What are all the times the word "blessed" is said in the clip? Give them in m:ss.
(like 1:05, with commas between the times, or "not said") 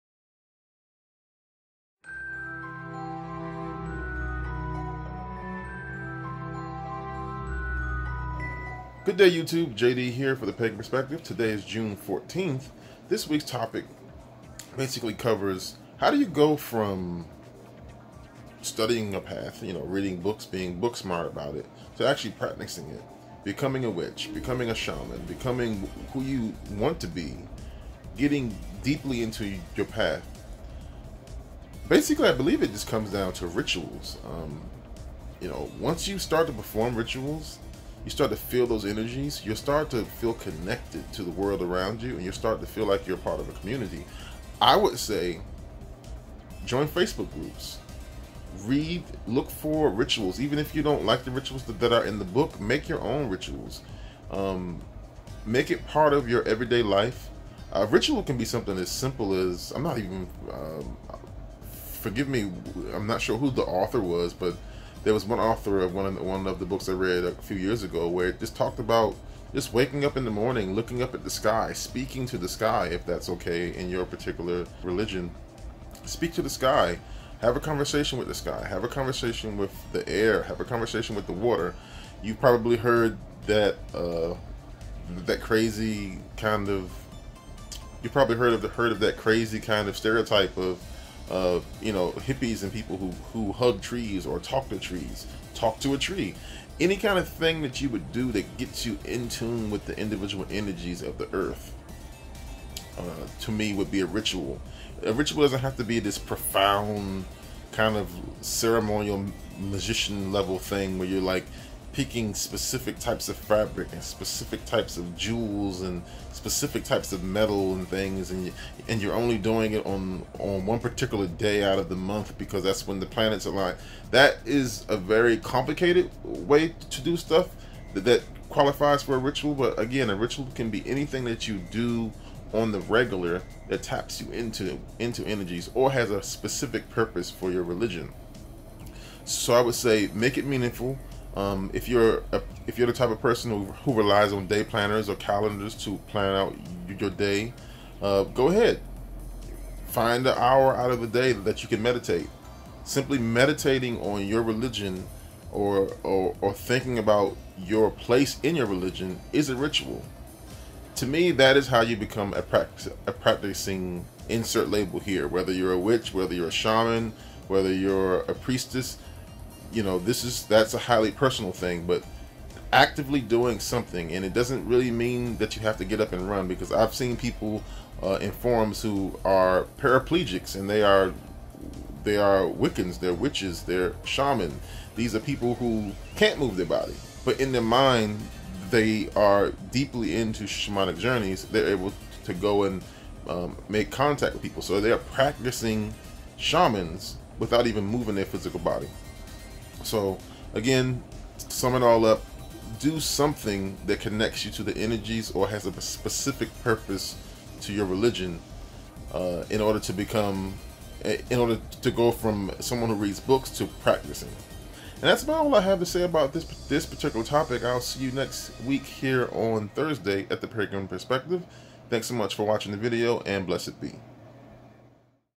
3:43.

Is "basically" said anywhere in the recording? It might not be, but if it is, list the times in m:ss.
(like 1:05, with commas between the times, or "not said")
0:14, 0:31.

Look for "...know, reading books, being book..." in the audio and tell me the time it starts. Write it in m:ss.
0:19.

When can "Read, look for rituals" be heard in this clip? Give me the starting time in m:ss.
0:48.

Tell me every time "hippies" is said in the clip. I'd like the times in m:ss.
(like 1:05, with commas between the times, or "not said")
1:32.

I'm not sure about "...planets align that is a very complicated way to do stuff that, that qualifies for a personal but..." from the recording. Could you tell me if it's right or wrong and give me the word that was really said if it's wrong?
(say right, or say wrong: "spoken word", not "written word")
wrong: "ritual", not "personal".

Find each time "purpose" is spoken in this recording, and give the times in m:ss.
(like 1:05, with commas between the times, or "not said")
2:16, 3:26.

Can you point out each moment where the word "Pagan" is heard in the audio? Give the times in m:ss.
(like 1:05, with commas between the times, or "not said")
0:10, 3:40.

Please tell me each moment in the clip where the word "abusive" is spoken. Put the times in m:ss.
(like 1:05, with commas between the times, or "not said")
not said.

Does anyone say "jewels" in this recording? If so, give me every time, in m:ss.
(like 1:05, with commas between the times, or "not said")
1:55.